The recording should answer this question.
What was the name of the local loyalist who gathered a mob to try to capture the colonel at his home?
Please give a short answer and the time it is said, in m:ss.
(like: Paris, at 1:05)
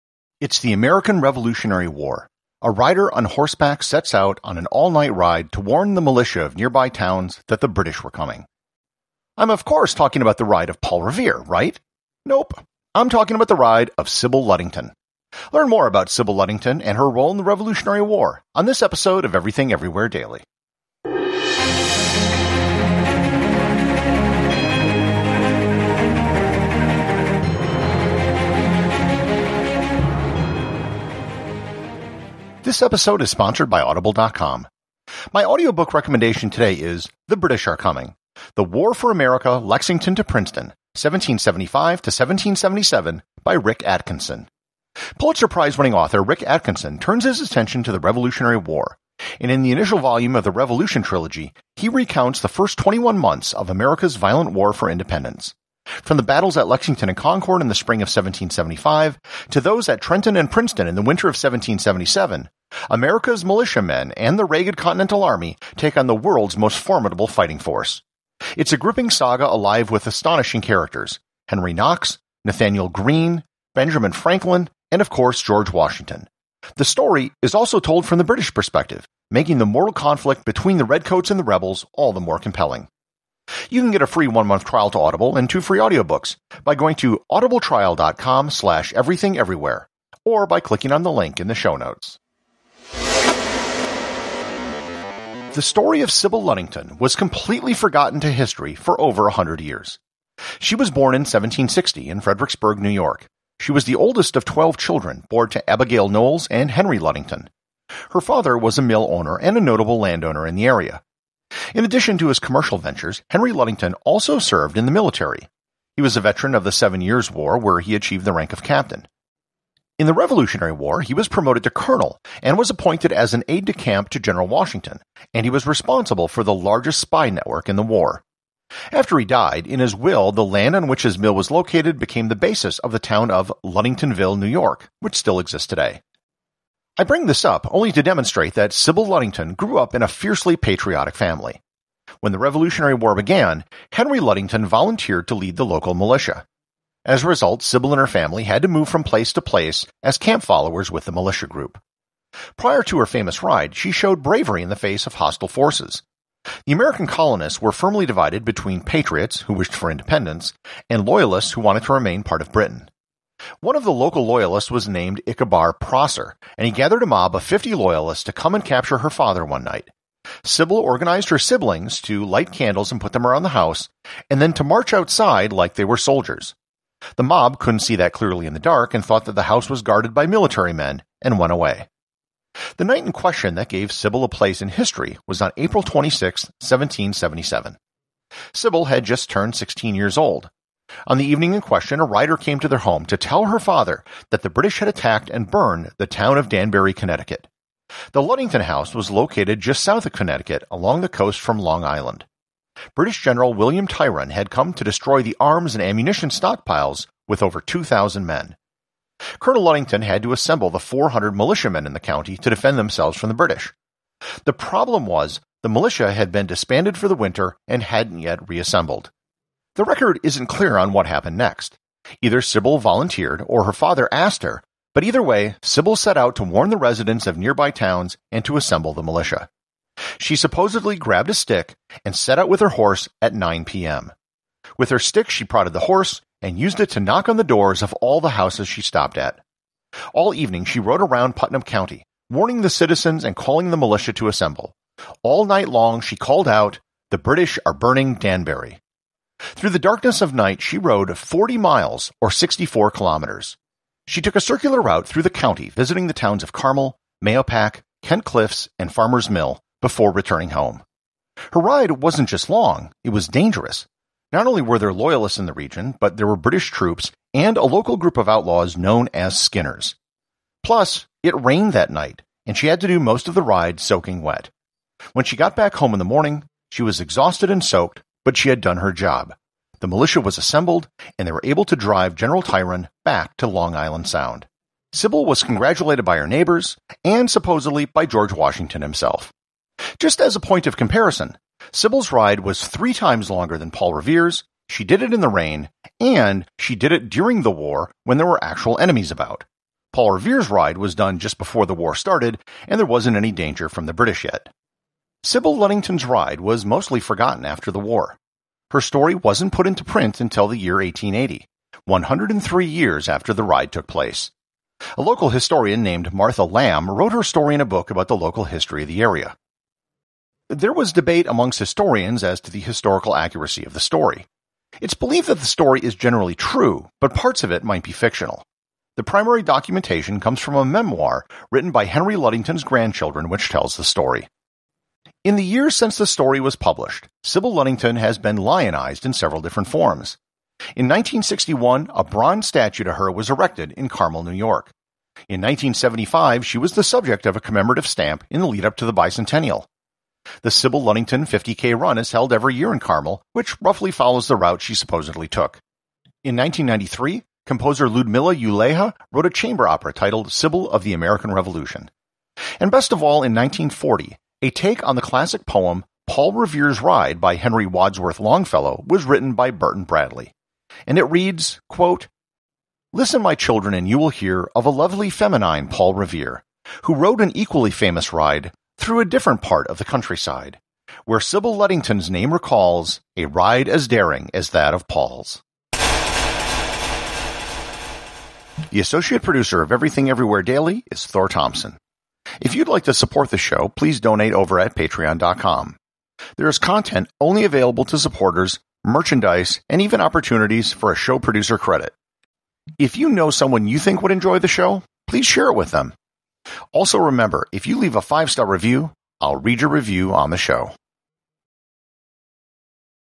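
Ichabod Prosser, at 2:45.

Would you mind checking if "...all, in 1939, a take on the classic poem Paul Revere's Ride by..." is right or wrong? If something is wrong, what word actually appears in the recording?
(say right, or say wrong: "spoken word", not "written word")
wrong: "1940", not "1939".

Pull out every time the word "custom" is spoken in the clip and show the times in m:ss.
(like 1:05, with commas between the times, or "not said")
not said.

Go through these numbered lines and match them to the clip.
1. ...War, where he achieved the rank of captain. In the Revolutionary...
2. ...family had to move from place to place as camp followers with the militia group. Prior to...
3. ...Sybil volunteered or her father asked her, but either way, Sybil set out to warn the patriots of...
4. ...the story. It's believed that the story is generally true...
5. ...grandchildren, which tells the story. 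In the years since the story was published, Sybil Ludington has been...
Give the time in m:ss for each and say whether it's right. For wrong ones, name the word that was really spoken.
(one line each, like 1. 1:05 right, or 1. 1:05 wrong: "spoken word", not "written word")
1. 1:57 right
2. 2:28 right
3. 3:42 wrong: "residents", not "patriots"
4. 5:23 right
5. 5:32 right.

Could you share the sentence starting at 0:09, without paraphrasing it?
I'm, of course, talking about the ride of Paul Revere, right?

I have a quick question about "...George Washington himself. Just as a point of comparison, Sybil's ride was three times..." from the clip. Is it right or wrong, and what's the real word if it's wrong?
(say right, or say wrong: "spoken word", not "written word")
right.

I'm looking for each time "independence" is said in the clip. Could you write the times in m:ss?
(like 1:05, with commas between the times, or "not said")
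0:54, 2:39.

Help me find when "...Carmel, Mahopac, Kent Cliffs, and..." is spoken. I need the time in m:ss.
4:16.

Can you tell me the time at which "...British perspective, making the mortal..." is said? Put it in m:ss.
1:18.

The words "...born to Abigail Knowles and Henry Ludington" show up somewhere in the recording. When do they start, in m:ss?
1:45.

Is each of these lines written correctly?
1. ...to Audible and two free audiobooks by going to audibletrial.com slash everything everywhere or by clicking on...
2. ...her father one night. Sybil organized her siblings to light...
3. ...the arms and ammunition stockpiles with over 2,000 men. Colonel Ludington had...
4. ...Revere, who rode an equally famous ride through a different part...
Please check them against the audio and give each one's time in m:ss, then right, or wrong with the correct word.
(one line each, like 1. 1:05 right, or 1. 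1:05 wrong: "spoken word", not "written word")
1. 1:24 right
2. 2:48 right
3. 3:25 right
4. 6:15 right.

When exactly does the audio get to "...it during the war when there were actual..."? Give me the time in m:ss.
4:56.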